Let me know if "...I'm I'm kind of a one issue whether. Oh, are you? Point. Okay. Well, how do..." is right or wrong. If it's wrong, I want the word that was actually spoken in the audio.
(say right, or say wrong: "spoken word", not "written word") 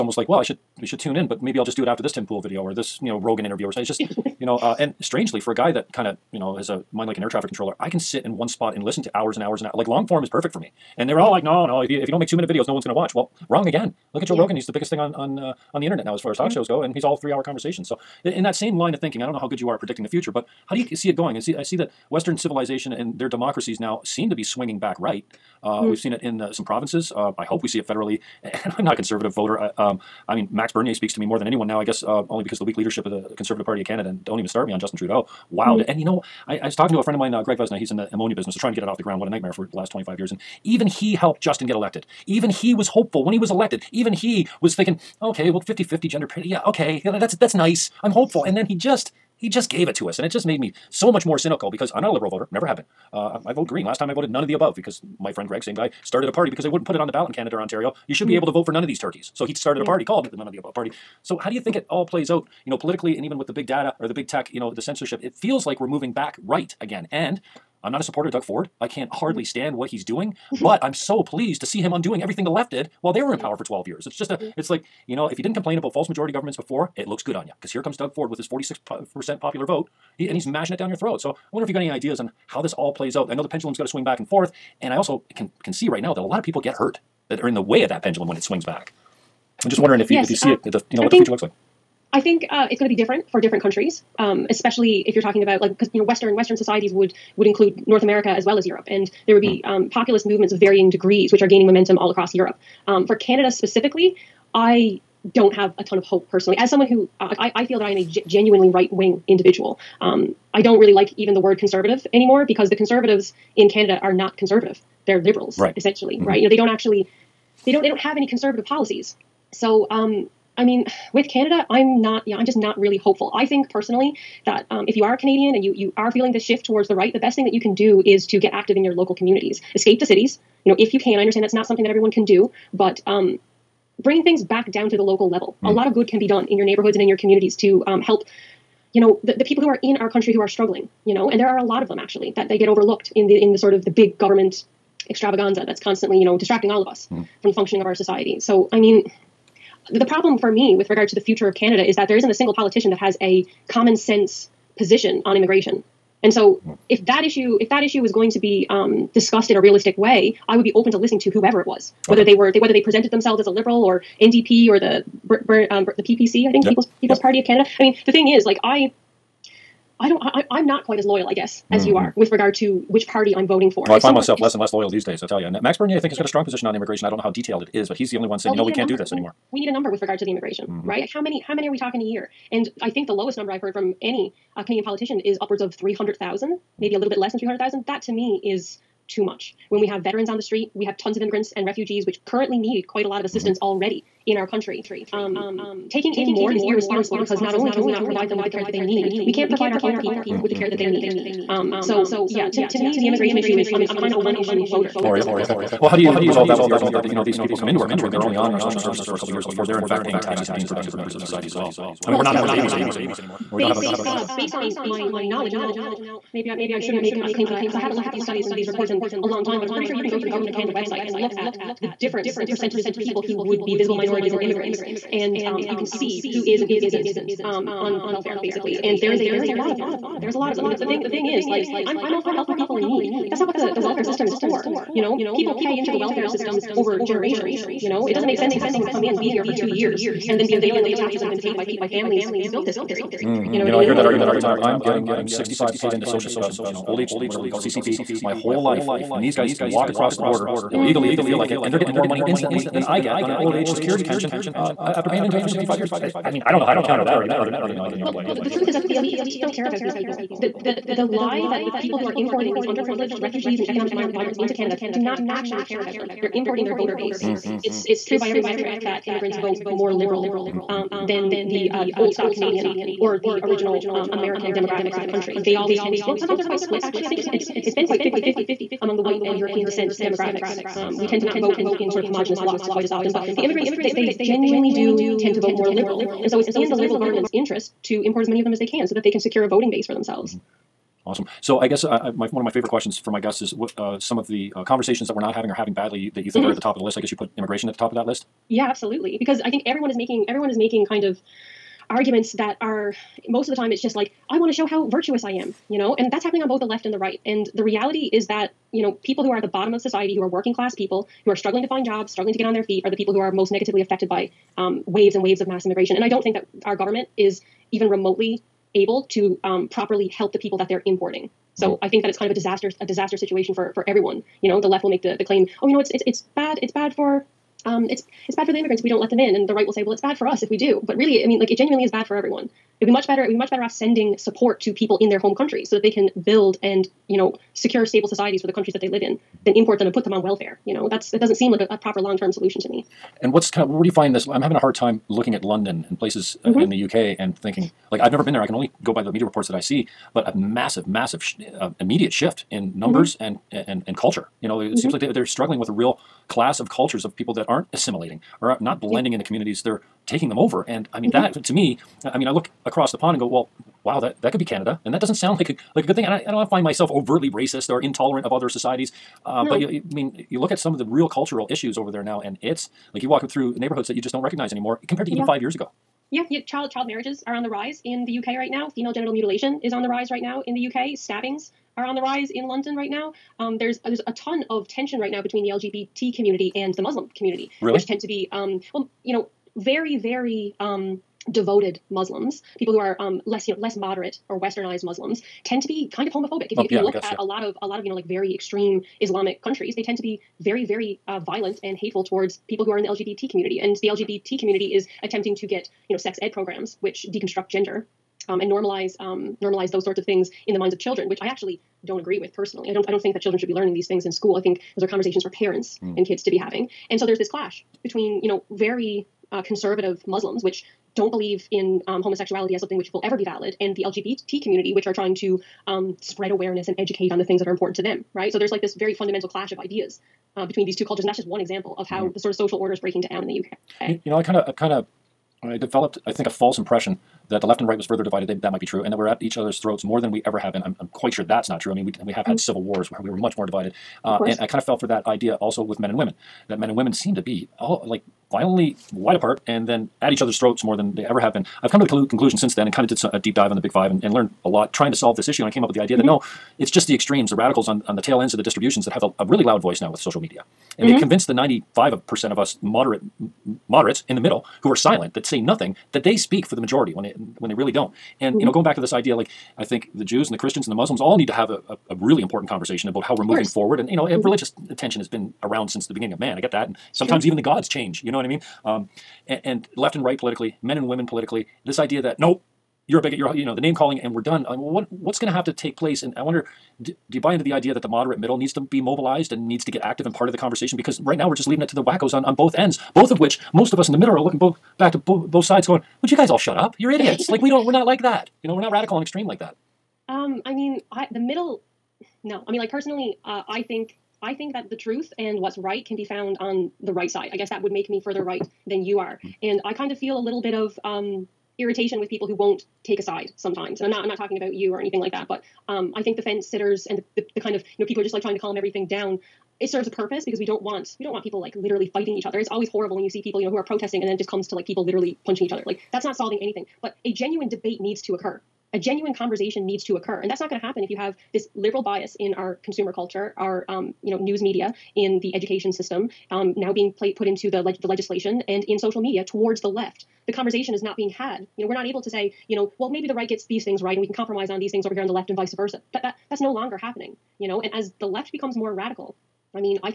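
wrong: "voter", not "whether".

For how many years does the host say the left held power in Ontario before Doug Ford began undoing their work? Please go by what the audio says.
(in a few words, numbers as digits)
12.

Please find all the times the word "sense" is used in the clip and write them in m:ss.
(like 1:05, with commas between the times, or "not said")
2:33, 3:58.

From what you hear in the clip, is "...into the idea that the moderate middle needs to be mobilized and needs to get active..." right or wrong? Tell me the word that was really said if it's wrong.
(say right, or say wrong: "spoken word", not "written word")
right.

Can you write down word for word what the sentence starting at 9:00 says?
The conversation is not being had.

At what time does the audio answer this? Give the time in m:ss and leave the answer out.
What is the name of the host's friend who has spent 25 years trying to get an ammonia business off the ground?
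0:37.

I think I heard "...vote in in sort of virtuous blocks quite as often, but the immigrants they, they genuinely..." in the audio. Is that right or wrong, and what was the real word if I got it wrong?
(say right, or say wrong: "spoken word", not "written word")
wrong: "homogenous", not "virtuous".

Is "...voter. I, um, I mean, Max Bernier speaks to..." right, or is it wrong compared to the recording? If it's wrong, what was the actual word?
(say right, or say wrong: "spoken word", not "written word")
right.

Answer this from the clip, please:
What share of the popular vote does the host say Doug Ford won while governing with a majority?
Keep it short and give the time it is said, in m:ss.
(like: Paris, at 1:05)
46%, at 1:18.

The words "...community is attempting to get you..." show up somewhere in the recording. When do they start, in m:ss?
6:44.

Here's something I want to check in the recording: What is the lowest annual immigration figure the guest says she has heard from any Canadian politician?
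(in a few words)
300,000.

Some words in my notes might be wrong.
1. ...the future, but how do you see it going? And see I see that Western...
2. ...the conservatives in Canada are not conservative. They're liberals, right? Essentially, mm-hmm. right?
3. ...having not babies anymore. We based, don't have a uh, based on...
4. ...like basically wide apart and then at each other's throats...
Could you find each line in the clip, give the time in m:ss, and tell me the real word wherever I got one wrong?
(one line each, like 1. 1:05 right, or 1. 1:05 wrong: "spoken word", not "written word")
1. 0:20 right
2. 1:52 right
3. 3:32 right
4. 7:27 wrong: "violently", not "basically".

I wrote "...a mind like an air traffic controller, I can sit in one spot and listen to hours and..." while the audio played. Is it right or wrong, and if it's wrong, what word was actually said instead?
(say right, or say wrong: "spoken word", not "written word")
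right.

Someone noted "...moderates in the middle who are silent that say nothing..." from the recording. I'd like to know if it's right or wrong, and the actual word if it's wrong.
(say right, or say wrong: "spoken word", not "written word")
right.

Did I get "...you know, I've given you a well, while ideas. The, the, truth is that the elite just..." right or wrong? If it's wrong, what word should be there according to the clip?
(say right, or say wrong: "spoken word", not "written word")
wrong: "couple", not "while".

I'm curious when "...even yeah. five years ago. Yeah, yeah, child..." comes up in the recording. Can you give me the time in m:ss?
6:15.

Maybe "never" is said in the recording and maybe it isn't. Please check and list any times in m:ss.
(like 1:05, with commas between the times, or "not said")
0:52, 5:48.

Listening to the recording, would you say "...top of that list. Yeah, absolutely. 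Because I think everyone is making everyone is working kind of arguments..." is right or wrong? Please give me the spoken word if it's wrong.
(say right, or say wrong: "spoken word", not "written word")
wrong: "making", not "working".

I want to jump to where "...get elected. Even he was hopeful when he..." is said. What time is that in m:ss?
0:41.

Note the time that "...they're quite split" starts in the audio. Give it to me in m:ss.
4:36.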